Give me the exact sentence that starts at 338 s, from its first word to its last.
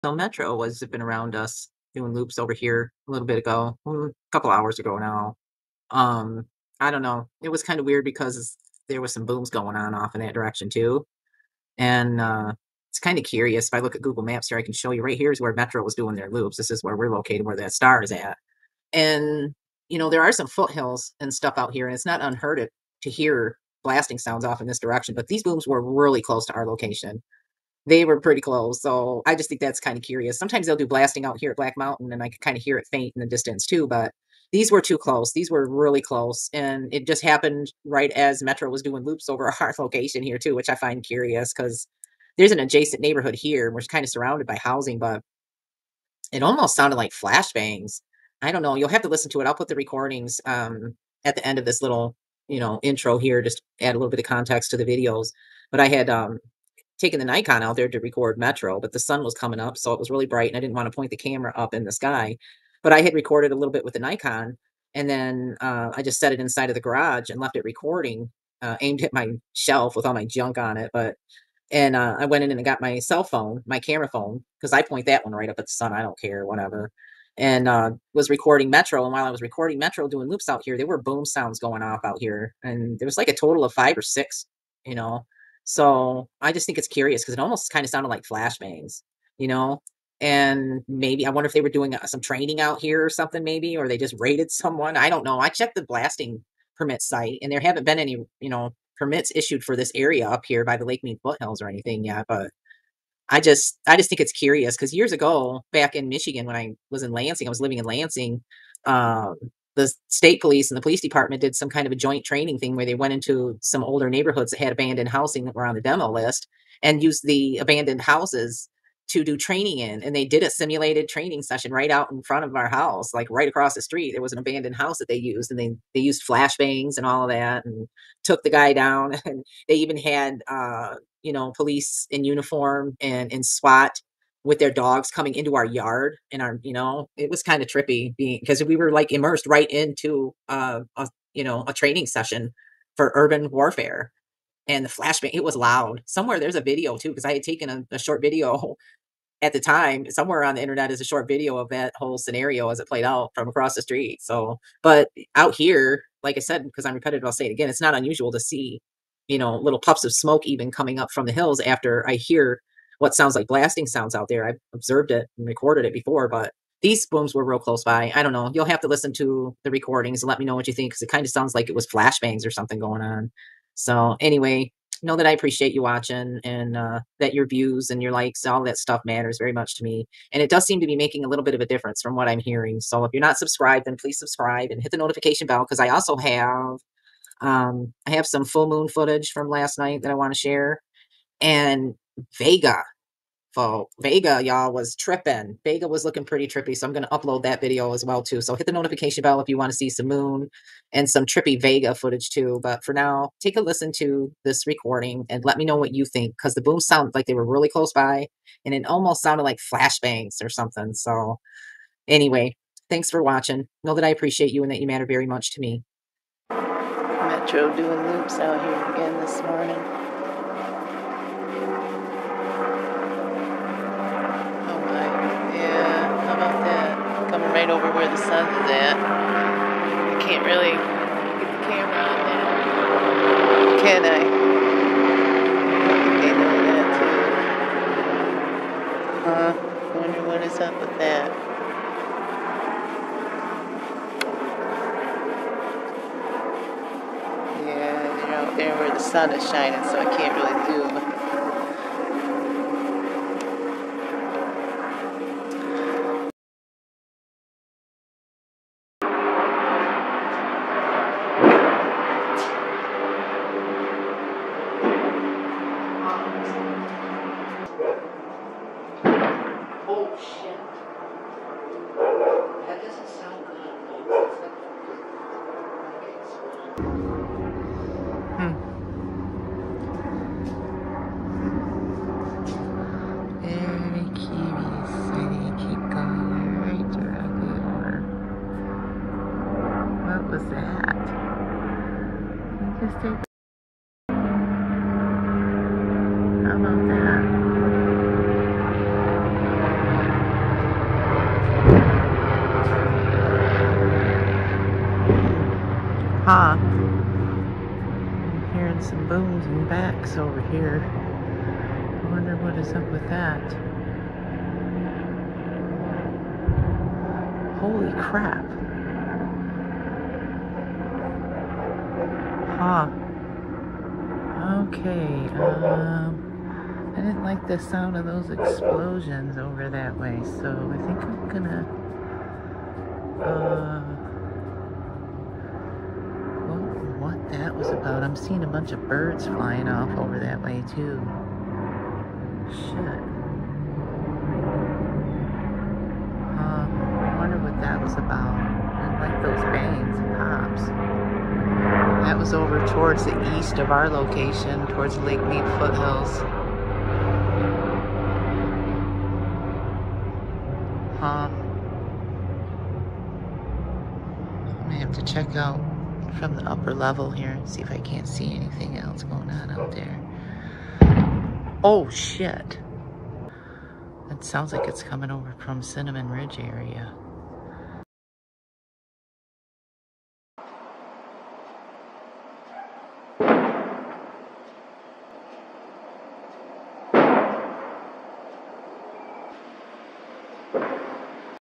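I'm seeing a bunch of birds flying off over that way too.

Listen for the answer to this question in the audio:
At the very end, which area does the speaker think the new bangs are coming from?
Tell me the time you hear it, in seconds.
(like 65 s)
375 s.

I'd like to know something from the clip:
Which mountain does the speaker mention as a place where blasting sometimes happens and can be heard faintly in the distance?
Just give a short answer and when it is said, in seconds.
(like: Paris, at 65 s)
Black Mountain, at 31 s.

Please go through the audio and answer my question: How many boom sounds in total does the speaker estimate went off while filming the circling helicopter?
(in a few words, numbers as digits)
5 or 6.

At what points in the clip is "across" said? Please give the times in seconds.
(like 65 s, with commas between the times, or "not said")
123 s, 153 s.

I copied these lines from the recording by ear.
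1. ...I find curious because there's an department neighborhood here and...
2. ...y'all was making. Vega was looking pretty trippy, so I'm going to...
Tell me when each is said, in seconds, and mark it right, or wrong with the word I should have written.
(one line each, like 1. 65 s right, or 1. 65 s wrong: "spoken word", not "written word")
1. 40 s wrong: "adjacent", not "department"
2. 194 s wrong: "tripping", not "making".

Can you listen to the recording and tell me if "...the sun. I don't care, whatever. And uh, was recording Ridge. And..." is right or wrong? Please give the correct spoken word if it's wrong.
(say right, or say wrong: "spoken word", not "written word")
wrong: "Metro", not "Ridge".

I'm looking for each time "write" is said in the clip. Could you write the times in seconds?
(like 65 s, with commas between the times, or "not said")
not said.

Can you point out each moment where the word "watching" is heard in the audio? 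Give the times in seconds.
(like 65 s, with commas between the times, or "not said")
175 s, 213 s.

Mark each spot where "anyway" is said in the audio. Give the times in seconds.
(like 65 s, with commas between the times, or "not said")
174 s, 212 s.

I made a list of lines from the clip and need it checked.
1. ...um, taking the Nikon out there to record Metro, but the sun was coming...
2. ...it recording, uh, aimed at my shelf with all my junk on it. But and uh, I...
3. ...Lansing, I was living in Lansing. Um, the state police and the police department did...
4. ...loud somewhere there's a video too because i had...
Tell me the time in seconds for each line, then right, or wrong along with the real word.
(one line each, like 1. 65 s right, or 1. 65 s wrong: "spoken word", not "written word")
1. 56 s right
2. 67 s right
3. 107 s right
4. 145 s right.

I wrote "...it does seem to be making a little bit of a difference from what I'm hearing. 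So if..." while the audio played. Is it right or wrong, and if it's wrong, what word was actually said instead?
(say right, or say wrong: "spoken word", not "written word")
right.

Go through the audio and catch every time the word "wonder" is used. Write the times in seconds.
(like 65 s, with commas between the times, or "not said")
91 s, 239 s, 312 s, 347 s.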